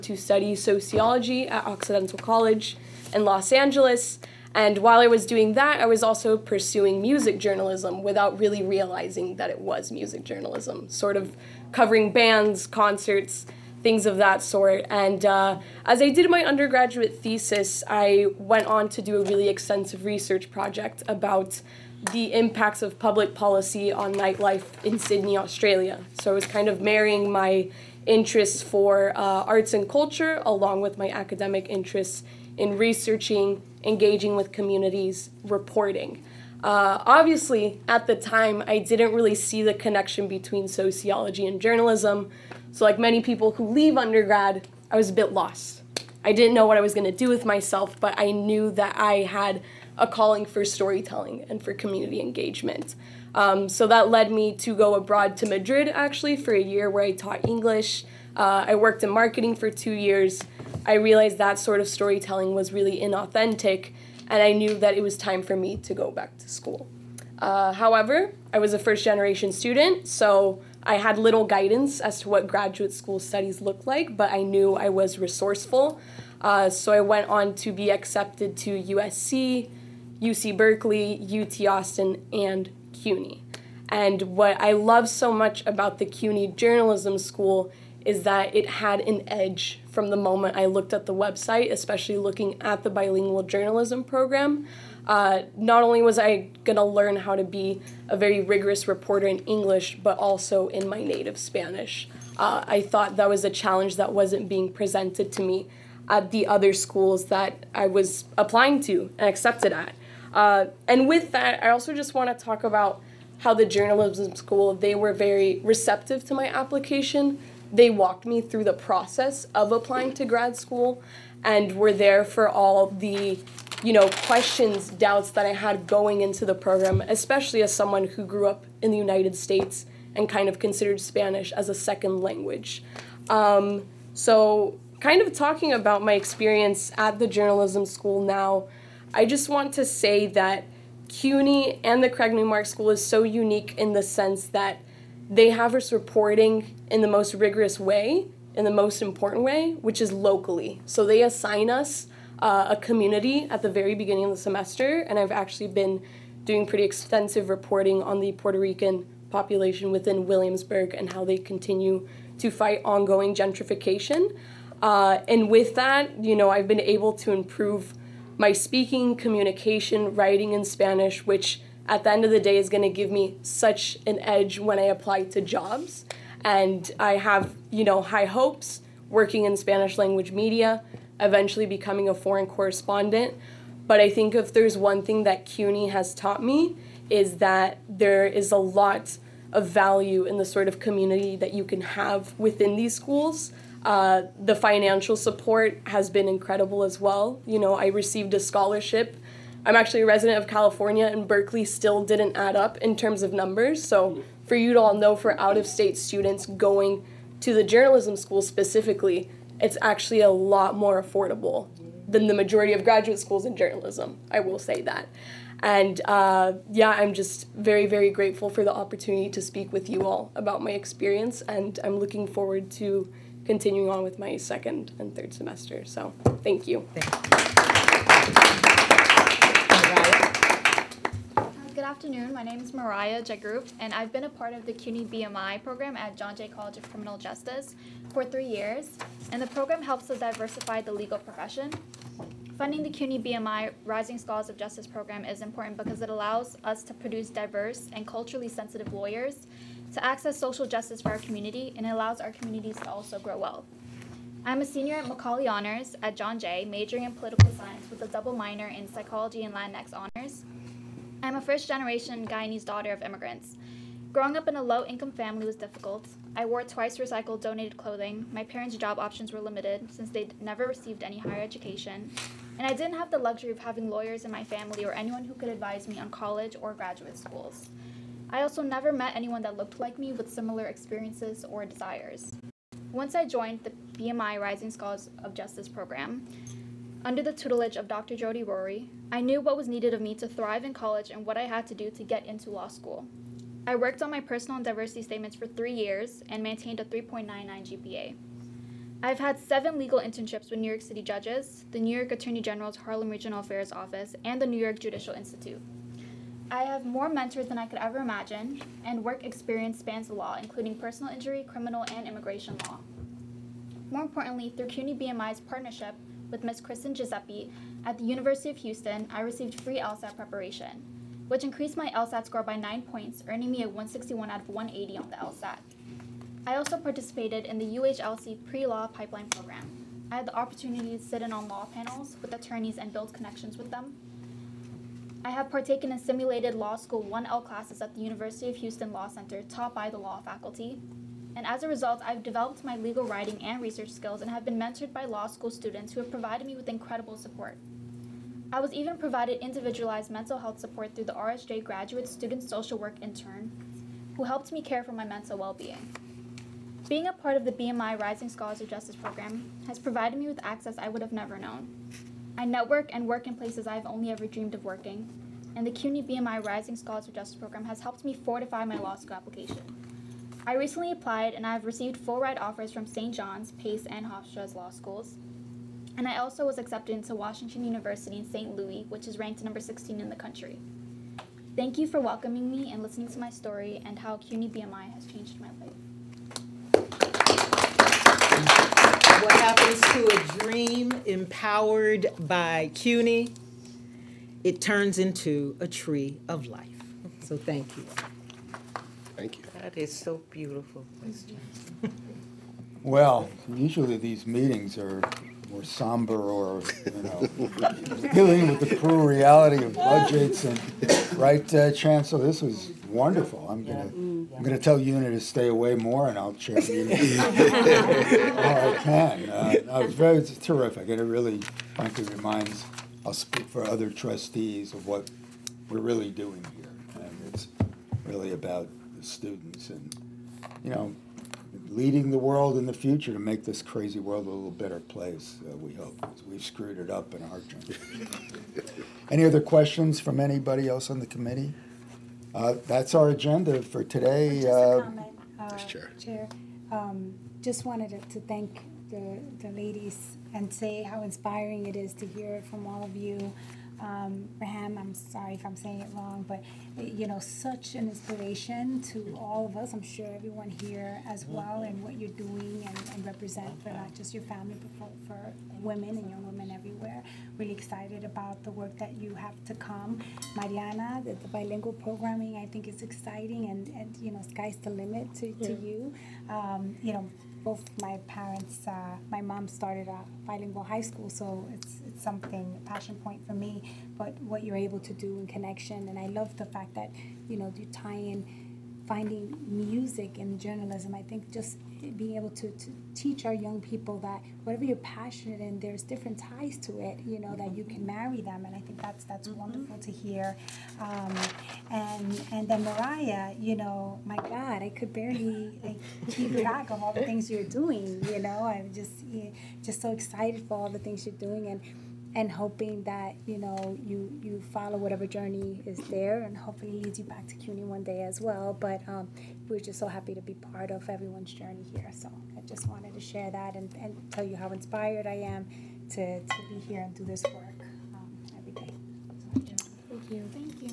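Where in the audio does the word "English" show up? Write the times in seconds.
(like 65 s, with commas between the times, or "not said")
57 s, 99 s.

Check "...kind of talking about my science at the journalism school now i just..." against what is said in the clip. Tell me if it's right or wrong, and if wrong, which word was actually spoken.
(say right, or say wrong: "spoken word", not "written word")
wrong: "experience", not "science".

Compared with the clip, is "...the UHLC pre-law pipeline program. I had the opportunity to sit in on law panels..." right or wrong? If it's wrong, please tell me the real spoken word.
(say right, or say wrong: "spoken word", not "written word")
right.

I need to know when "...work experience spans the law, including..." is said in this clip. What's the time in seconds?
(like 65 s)
309 s.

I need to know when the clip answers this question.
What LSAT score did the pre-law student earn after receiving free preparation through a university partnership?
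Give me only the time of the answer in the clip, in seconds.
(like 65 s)
323 s.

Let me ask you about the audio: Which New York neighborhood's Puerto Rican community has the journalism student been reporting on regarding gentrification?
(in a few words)
Williamsburg.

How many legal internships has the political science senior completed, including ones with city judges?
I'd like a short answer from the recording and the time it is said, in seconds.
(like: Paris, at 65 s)
7, at 299 s.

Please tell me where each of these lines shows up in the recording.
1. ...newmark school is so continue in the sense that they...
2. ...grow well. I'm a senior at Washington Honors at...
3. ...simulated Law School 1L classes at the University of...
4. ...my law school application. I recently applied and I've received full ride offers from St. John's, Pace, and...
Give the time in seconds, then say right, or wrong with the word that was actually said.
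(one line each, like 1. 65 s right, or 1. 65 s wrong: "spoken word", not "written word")
1. 142 s wrong: "unique", not "continue"
2. 253 s wrong: "Macaulay", not "Washington"
3. 335 s right
4. 368 s right.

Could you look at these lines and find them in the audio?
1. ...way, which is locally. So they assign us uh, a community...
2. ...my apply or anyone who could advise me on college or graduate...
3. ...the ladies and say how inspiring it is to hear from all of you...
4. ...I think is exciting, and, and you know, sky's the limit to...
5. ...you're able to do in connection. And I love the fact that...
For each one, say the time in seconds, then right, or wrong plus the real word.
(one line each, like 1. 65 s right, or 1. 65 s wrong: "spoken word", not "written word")
1. 149 s right
2. 274 s wrong: "family", not "apply"
3. 449 s right
4. 472 s right
5. 484 s right.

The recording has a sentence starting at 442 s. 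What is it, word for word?
Uh, that's our agenda for today.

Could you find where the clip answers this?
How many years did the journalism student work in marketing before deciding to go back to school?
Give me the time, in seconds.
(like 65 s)
59 s.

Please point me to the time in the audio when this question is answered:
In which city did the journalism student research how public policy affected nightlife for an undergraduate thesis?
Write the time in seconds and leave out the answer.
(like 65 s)
24 s.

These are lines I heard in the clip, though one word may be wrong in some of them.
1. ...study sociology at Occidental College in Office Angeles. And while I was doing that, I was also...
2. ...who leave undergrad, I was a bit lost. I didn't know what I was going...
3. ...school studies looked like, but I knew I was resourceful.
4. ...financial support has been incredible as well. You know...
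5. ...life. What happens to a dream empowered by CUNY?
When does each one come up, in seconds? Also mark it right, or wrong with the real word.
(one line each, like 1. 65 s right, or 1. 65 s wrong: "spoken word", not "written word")
1. 0 s wrong: "Los", not "Office"
2. 43 s right
3. 72 s right
4. 194 s right
5. 385 s right.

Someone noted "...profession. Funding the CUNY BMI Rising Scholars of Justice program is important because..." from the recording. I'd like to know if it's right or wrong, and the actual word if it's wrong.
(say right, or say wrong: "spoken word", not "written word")
right.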